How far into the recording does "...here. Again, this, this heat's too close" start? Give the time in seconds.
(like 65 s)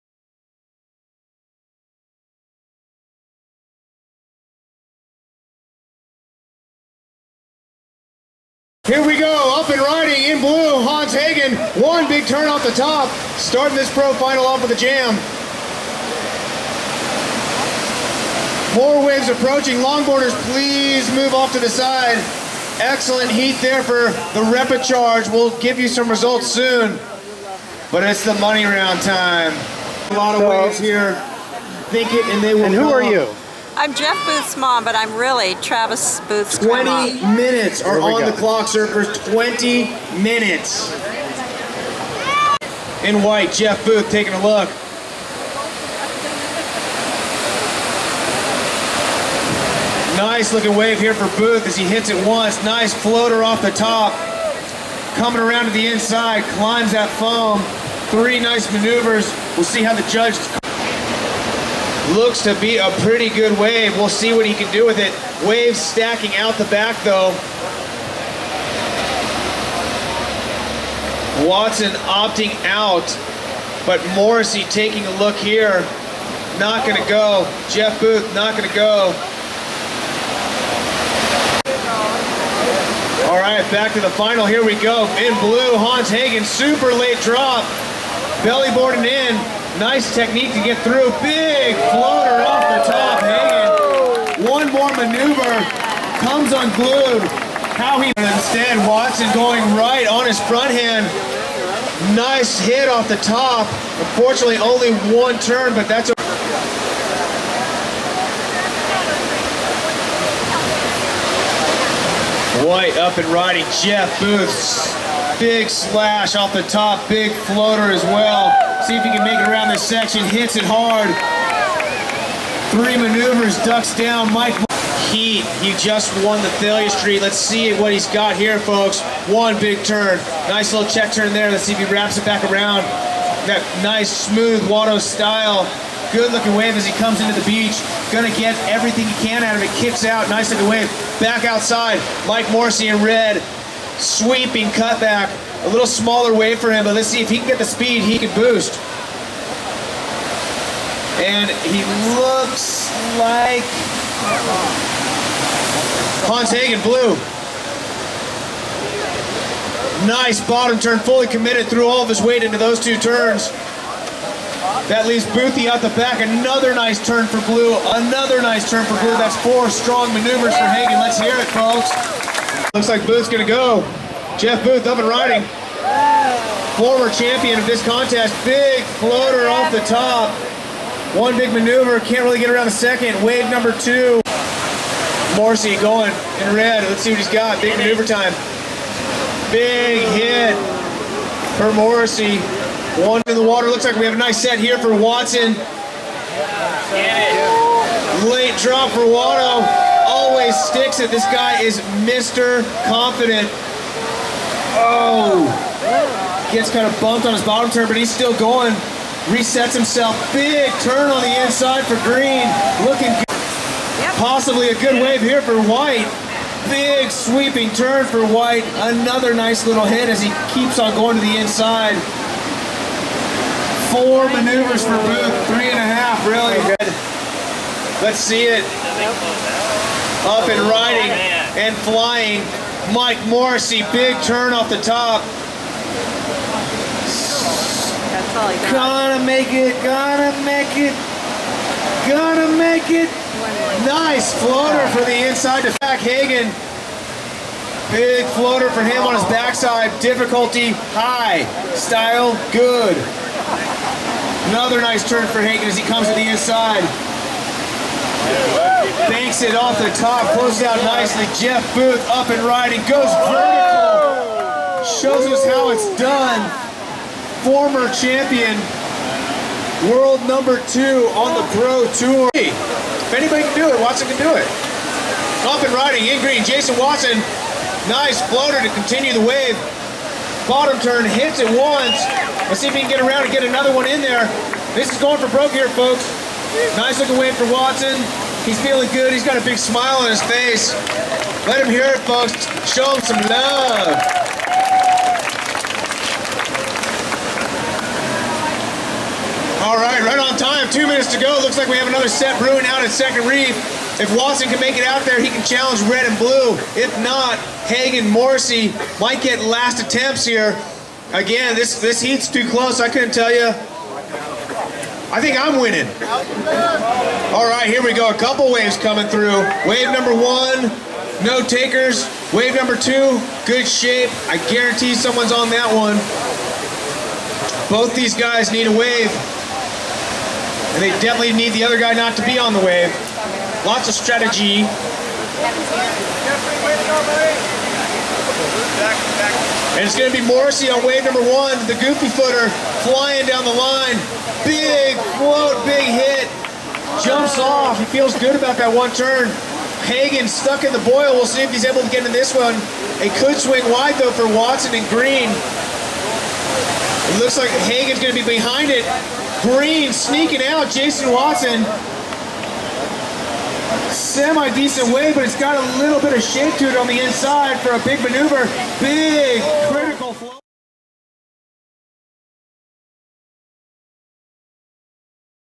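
310 s.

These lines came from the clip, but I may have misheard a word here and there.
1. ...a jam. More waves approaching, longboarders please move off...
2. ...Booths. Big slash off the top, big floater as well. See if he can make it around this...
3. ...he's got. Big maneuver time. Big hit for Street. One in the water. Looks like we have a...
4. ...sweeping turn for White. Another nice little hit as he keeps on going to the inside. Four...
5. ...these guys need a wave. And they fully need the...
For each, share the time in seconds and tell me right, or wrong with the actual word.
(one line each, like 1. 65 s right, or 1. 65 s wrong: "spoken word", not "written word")
1. 14 s right
2. 114 s right
3. 187 s wrong: "Morrissey", not "Street"
4. 217 s right
5. 327 s wrong: "definitely", not "fully".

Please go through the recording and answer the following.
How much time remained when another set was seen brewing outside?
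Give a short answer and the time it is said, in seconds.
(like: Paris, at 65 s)
2 minutes, at 300 s.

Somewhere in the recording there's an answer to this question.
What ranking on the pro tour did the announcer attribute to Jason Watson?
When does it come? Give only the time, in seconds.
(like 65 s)
269 s.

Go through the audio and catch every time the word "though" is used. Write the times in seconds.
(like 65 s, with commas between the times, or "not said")
67 s, 353 s.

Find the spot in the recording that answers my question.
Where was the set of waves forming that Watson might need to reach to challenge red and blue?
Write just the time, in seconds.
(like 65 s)
302 s.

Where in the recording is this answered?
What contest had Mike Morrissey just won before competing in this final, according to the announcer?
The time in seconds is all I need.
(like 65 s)
126 s.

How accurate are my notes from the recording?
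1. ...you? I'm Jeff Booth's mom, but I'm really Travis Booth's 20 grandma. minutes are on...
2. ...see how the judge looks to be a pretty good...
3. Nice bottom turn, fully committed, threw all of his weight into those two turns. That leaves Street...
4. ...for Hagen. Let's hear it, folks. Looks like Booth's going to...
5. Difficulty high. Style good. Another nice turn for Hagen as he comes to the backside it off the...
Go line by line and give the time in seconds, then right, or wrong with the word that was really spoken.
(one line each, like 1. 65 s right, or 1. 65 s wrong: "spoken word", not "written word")
1. 33 s right
2. 59 s right
3. 160 s wrong: "Boothie", not "Street"
4. 170 s right
5. 250 s wrong: "inside", not "backside".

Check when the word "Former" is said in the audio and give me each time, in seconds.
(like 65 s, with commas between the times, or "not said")
176 s, 267 s.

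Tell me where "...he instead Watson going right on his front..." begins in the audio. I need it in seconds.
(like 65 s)
97 s.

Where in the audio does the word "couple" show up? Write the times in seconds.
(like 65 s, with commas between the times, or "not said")
318 s.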